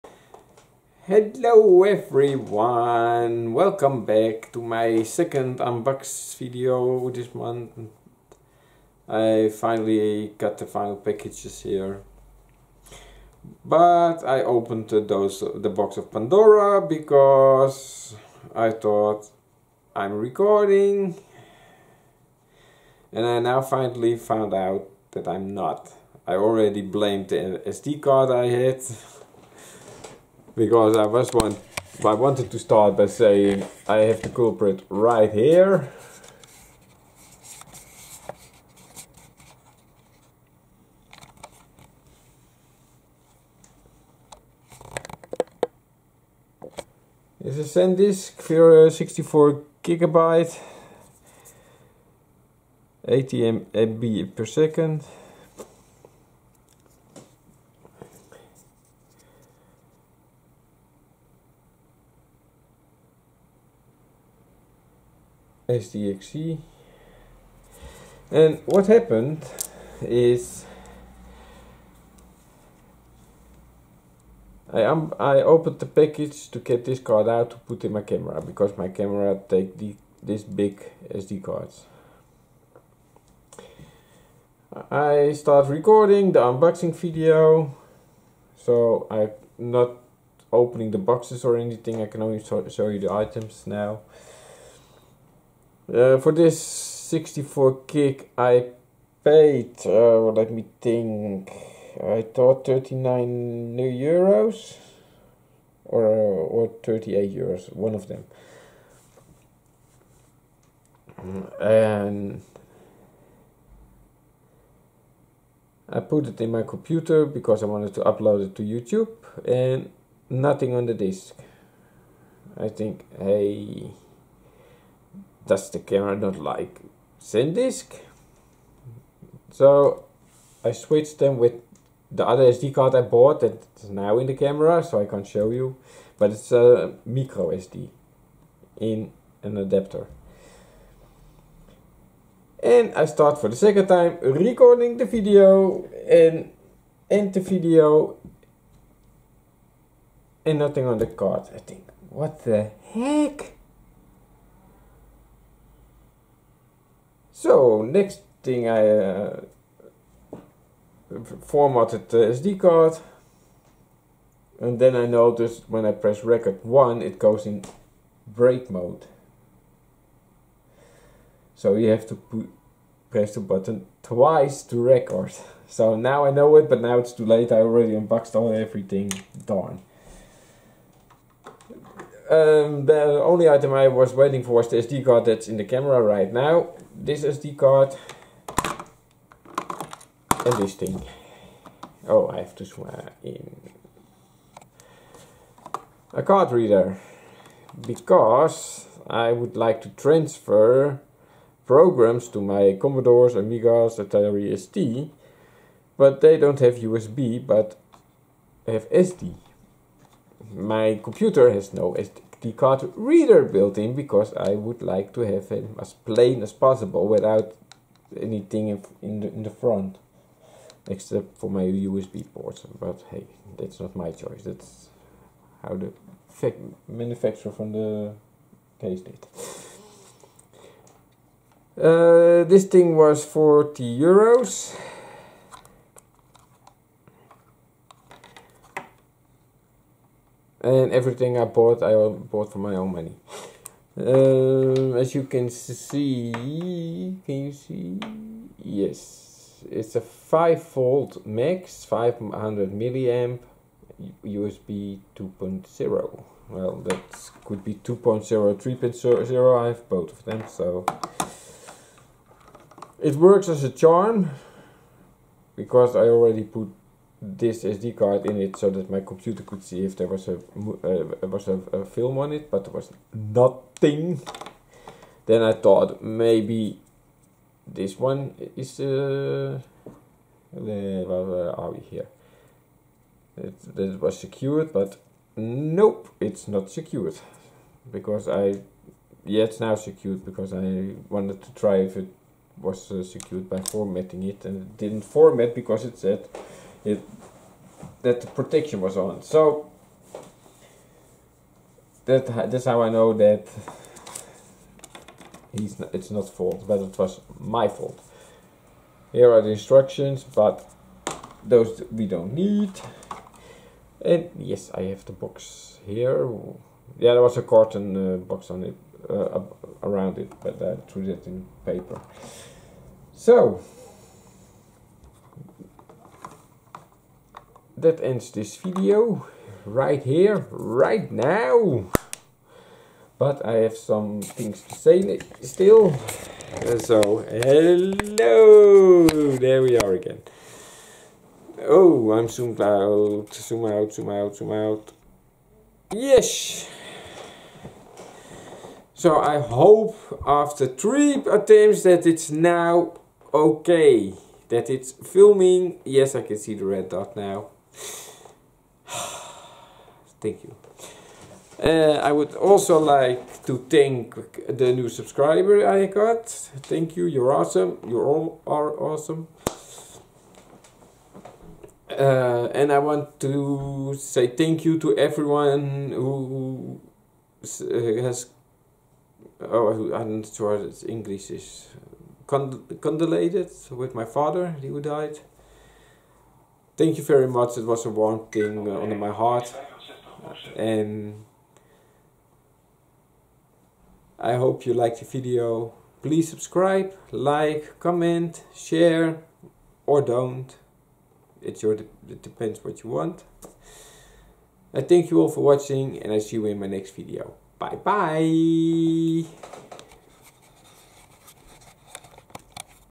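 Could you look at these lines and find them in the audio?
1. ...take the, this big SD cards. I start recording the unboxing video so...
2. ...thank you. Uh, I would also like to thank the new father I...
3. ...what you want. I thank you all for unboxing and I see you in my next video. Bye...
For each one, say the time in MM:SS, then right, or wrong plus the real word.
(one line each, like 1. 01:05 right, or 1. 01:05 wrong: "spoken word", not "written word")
1. 01:19 right
2. 06:00 wrong: "subscriber", not "father"
3. 06:42 wrong: "watching", not "unboxing".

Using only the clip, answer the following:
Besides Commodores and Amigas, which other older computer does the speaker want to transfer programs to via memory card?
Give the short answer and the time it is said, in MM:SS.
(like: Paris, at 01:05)
Atari ST, at 03:23.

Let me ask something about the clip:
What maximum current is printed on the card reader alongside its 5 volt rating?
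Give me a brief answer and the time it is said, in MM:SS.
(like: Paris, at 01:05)
500 milliamp, at 04:11.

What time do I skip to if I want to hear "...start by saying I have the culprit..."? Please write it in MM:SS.
00:32.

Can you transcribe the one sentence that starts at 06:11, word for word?
Uh, and I want to say thank you to everyone who uh, has.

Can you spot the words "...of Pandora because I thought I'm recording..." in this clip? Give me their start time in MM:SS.
00:15.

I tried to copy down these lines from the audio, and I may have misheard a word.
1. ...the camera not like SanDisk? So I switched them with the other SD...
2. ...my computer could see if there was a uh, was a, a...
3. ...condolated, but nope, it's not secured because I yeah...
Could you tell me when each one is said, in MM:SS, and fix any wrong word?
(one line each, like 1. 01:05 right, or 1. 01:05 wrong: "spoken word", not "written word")
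1. 02:05 right
2. 04:28 right
3. 04:44 wrong: "secured", not "condolated".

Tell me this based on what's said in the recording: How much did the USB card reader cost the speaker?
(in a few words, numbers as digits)
40 euros.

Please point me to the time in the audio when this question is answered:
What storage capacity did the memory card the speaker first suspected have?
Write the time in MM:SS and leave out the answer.
00:48.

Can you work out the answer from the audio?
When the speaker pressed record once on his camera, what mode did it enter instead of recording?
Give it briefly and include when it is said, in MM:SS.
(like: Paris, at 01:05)
break mode, at 02:48.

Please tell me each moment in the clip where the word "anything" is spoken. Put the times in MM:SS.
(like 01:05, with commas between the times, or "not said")
01:31, 03:38.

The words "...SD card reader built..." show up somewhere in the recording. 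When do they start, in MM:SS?
03:31.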